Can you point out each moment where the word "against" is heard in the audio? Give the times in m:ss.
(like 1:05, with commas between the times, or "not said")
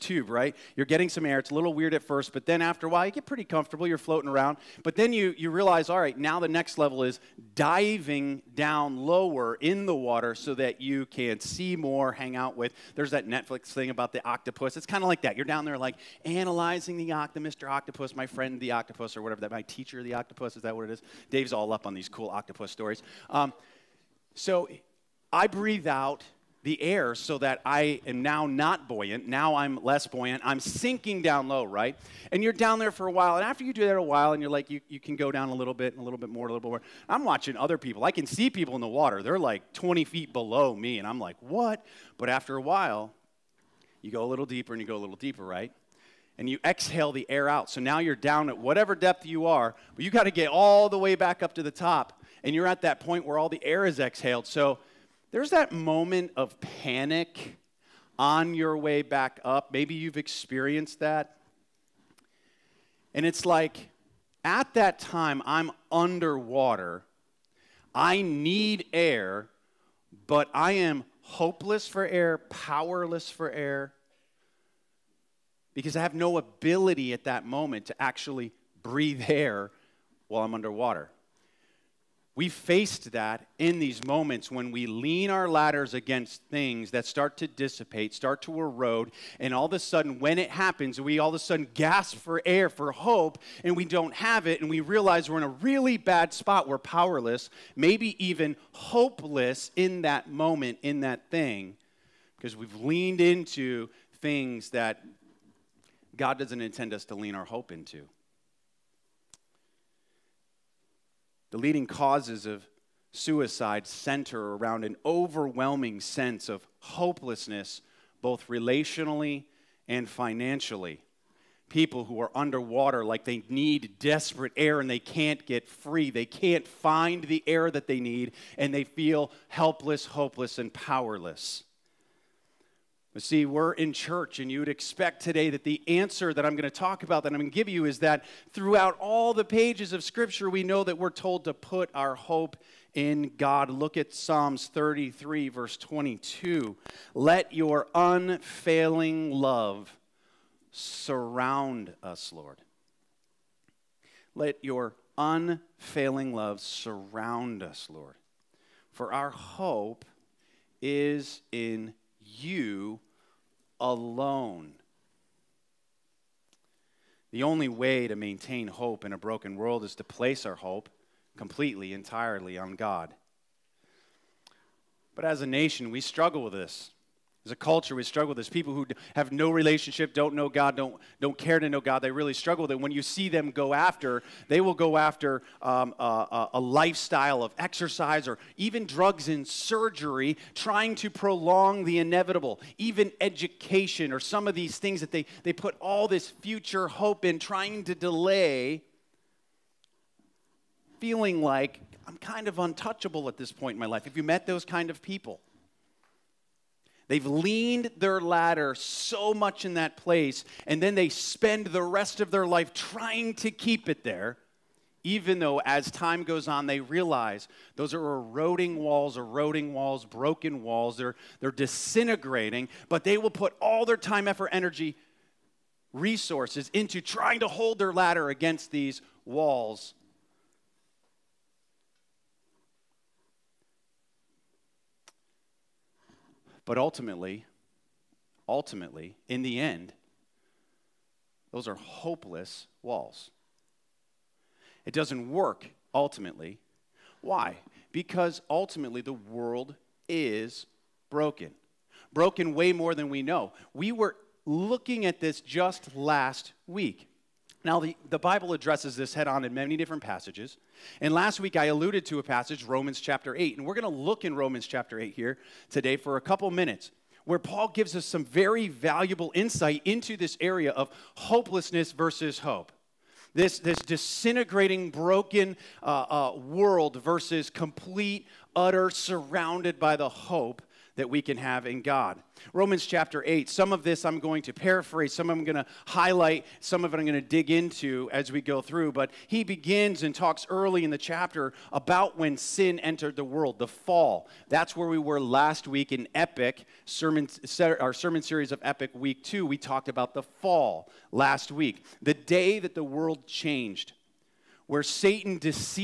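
1:25, 3:48.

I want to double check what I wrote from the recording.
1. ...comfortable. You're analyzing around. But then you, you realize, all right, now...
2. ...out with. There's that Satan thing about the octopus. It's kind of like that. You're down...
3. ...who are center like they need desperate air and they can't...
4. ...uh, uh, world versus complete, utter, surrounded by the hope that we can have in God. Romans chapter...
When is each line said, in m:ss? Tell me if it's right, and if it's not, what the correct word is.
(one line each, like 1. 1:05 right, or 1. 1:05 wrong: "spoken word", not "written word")
1. 0:03 wrong: "floating", not "analyzing"
2. 0:12 wrong: "Netflix", not "Satan"
3. 2:02 wrong: "underwater", not "center"
4. 4:35 right.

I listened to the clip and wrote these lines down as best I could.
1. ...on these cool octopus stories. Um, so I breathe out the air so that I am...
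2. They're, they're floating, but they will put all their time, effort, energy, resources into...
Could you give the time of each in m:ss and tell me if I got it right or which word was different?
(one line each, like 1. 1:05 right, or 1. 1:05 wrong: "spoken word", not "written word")
1. 0:21 right
2. 3:40 wrong: "disintegrating", not "floating".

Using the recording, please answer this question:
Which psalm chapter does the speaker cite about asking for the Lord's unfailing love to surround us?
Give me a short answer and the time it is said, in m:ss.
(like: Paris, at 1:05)
Psalms 33, at 2:24.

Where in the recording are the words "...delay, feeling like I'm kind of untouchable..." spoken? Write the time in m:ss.
3:17.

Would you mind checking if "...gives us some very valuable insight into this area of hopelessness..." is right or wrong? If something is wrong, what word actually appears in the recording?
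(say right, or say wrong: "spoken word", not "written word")
right.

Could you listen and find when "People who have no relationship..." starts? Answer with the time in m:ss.
2:58.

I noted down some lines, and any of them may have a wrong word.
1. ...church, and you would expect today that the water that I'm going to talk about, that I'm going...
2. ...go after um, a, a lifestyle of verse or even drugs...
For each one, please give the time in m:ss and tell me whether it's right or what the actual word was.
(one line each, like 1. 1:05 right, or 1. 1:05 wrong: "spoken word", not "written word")
1. 2:13 wrong: "answer", not "water"
2. 3:04 wrong: "exercise", not "verse".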